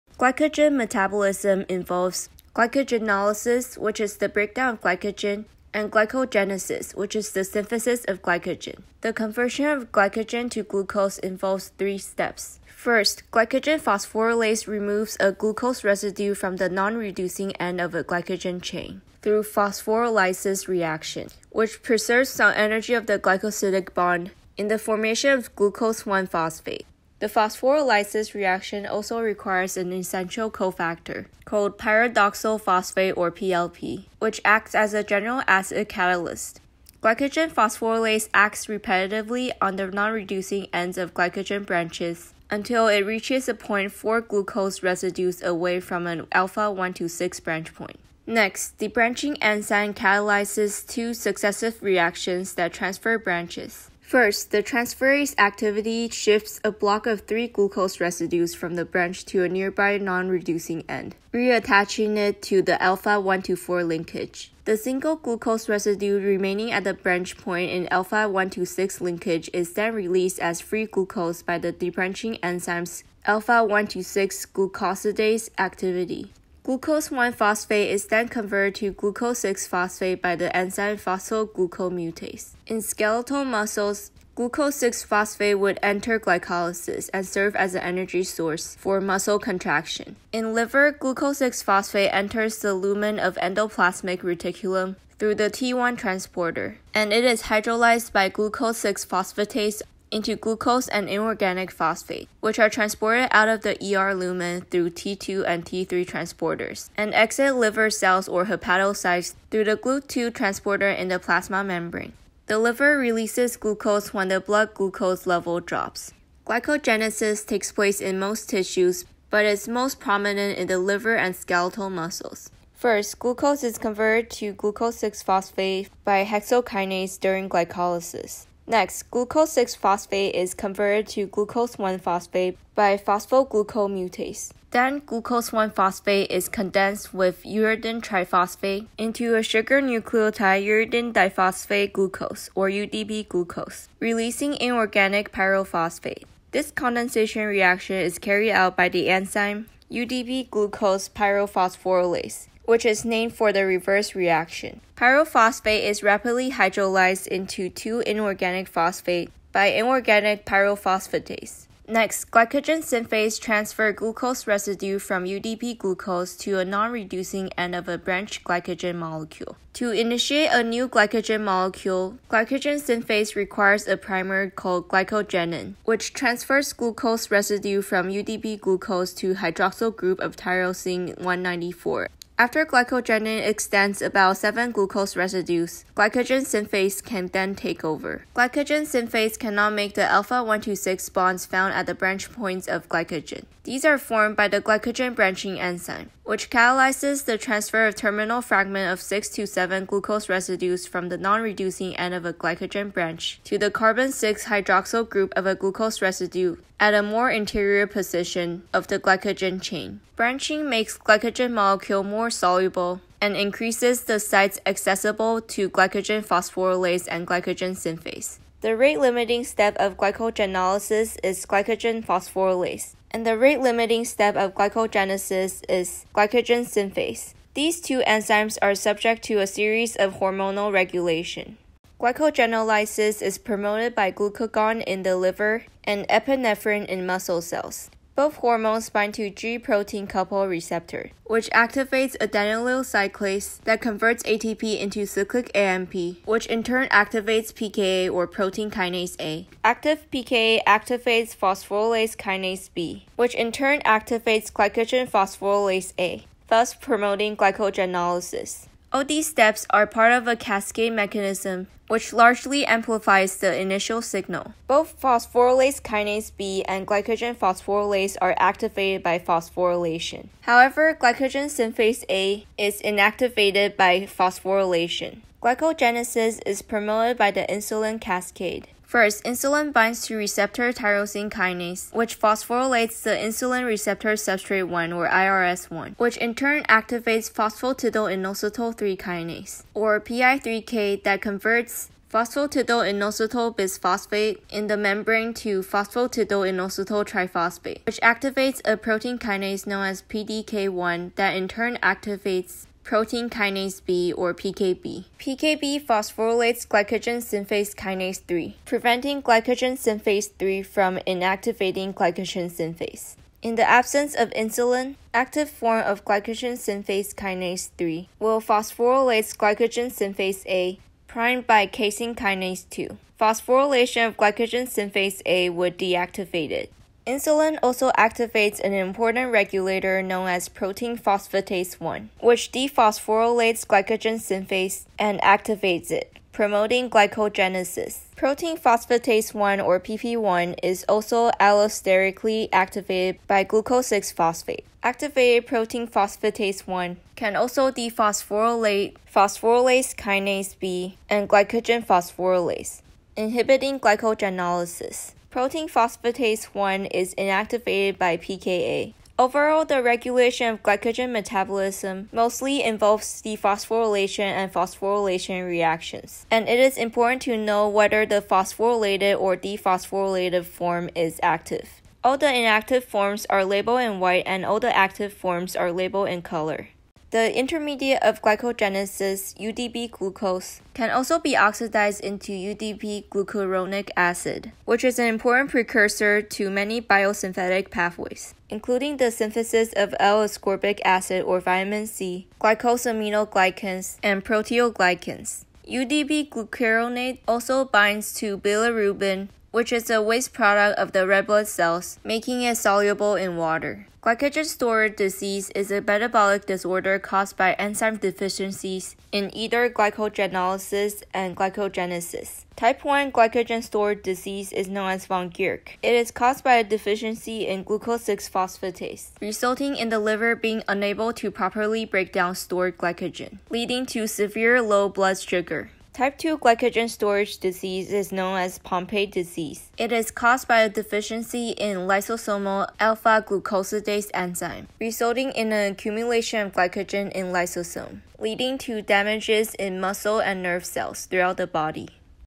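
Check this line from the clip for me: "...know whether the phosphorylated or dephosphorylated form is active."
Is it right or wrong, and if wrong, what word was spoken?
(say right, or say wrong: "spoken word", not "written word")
right.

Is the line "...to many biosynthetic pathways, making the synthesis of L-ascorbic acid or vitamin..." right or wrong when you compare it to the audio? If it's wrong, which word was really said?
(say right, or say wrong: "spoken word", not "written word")
wrong: "including", not "making".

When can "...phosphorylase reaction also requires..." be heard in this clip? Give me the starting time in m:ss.
0:27.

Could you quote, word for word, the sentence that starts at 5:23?
Phosphorylation of glycogen synthase A would deactivate it.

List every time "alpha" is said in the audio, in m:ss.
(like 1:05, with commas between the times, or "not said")
0:46, 1:02, 1:07, 1:13, 3:10, 7:12.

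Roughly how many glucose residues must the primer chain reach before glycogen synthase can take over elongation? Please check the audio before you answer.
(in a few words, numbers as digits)
7.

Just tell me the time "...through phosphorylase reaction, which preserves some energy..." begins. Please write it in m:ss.
0:19.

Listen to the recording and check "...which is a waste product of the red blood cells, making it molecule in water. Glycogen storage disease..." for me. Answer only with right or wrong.
wrong.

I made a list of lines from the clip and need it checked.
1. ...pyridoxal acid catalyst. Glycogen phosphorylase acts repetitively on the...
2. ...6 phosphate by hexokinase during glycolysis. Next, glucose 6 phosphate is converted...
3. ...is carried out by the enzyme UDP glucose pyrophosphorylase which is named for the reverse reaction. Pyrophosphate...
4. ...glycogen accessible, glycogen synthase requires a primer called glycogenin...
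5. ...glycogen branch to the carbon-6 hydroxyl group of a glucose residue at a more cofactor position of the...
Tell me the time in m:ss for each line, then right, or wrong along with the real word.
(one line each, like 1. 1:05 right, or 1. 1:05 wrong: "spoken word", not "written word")
1. 0:35 wrong: "general", not "pyridoxal"
2. 2:04 right
3. 2:27 right
4. 2:50 wrong: "molecule", not "accessible"
5. 3:22 wrong: "interior", not "cofactor".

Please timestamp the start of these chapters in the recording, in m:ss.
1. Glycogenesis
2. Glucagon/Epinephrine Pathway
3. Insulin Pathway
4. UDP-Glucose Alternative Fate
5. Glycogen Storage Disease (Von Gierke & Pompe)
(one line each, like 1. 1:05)
1. 1:56
2. 3:52
3. 4:35
4. 6:17
5. 6:44.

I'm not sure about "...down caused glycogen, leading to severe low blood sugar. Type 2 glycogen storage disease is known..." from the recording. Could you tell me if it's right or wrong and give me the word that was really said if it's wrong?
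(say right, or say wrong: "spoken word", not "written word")
wrong: "stored", not "caused".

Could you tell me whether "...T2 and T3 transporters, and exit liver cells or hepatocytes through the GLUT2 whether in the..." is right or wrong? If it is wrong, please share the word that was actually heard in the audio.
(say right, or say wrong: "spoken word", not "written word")
wrong: "transporter", not "whether".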